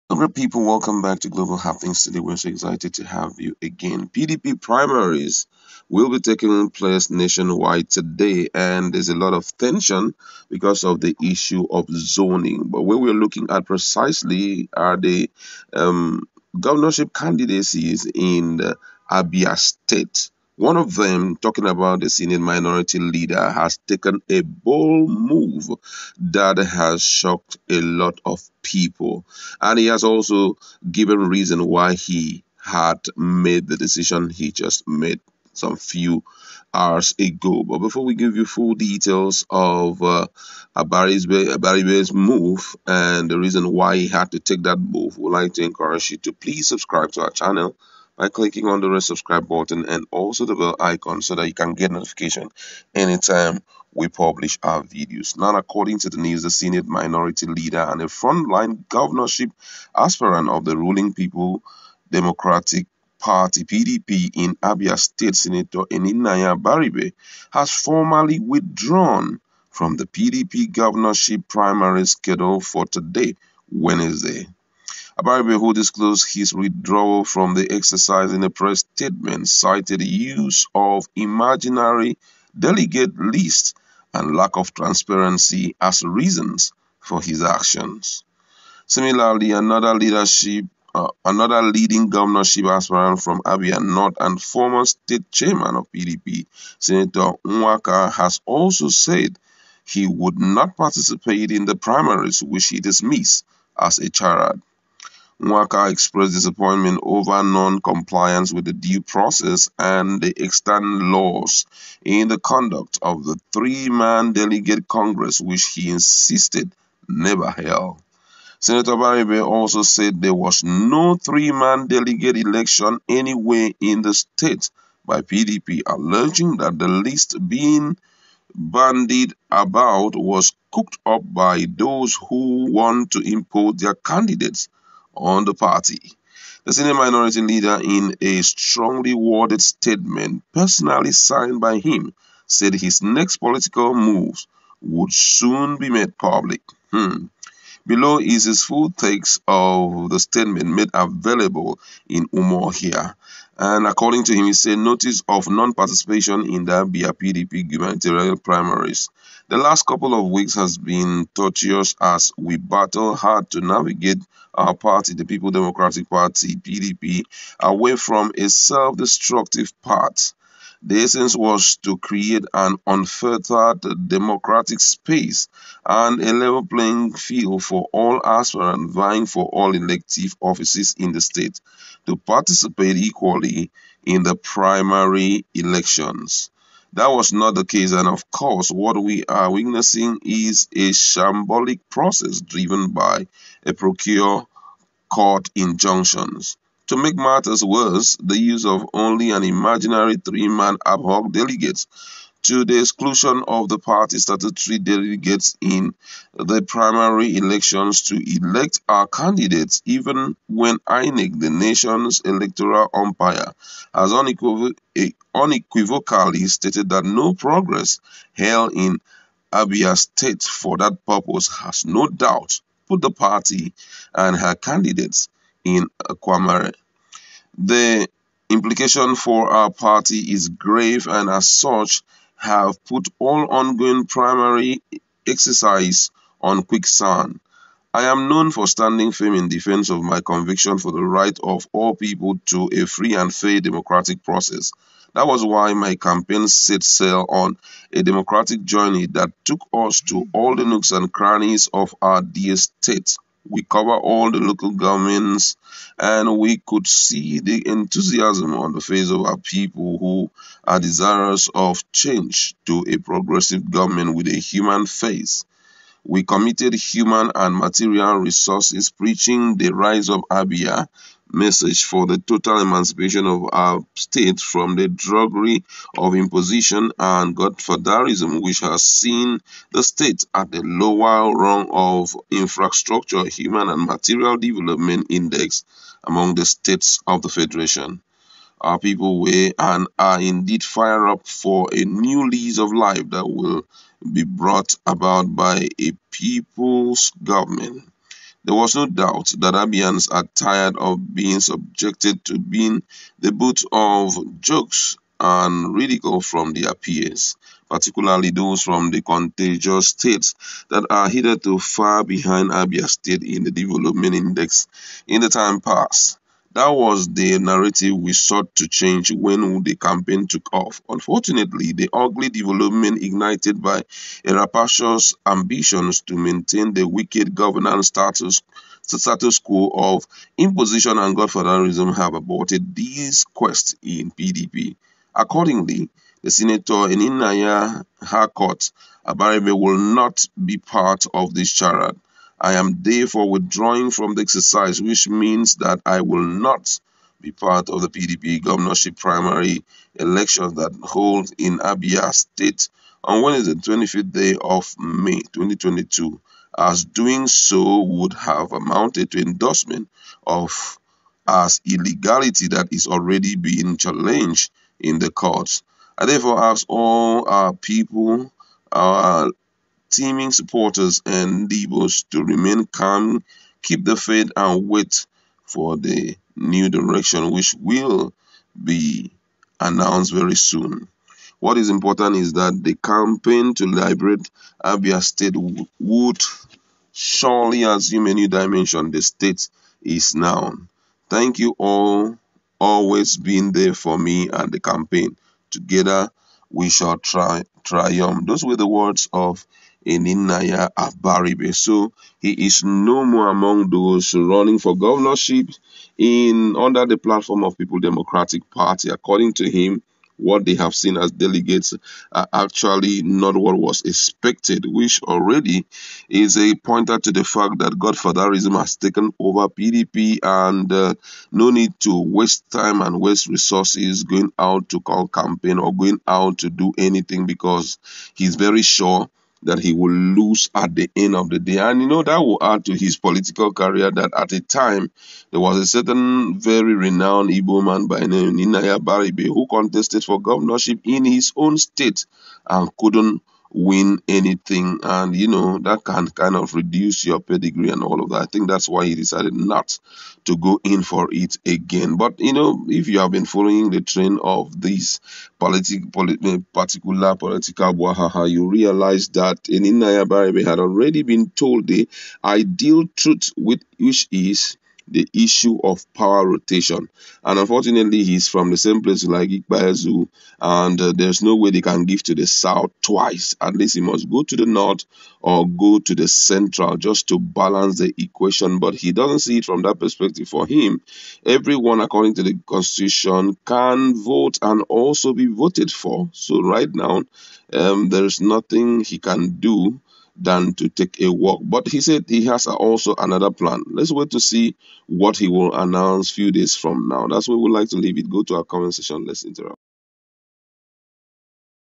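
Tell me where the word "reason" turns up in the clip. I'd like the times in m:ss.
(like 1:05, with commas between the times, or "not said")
0:31, 0:43, 1:26.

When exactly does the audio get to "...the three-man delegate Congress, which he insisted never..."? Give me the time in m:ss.
1:53.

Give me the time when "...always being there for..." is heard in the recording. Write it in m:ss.
6:32.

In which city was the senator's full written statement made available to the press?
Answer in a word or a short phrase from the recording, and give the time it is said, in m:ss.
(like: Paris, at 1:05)
Umuahia, at 2:32.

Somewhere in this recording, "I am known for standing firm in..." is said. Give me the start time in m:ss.
3:57.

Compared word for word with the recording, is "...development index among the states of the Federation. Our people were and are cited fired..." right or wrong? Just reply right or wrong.
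wrong.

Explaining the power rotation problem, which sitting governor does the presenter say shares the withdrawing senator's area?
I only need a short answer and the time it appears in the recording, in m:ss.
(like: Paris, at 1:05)
Ikpeazu, at 7:49.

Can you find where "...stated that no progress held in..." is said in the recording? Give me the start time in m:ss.
3:36.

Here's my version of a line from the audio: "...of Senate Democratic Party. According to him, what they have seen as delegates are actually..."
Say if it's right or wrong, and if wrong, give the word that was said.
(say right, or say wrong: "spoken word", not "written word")
wrong: "People", not "Senate".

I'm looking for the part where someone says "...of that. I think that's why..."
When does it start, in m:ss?
7:28.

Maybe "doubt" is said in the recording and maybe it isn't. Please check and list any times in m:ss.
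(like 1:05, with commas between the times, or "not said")
3:42, 4:58.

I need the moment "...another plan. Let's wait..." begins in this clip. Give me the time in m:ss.
8:12.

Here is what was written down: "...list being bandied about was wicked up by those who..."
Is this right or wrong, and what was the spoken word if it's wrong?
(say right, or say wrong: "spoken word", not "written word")
wrong: "cooked", not "wicked".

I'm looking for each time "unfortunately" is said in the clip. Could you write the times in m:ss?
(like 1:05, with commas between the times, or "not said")
5:20, 7:47.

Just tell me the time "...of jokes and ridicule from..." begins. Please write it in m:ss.
5:03.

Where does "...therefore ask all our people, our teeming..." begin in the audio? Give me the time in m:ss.
6:06.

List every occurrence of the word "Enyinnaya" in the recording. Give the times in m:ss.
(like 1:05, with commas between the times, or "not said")
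1:05, 5:36, 6:39, 7:18, 7:39.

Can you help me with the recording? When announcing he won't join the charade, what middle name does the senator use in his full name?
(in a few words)
Harcourt.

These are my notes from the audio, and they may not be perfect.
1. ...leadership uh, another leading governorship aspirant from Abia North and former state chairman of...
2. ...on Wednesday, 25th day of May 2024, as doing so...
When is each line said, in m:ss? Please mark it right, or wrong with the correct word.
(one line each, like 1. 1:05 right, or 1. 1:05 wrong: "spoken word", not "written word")
1. 1:29 right
2. 5:53 wrong: "2022", not "2024".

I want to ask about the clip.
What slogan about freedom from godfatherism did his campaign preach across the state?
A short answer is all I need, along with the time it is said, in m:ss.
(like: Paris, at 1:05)
Rise of Abia, at 4:29.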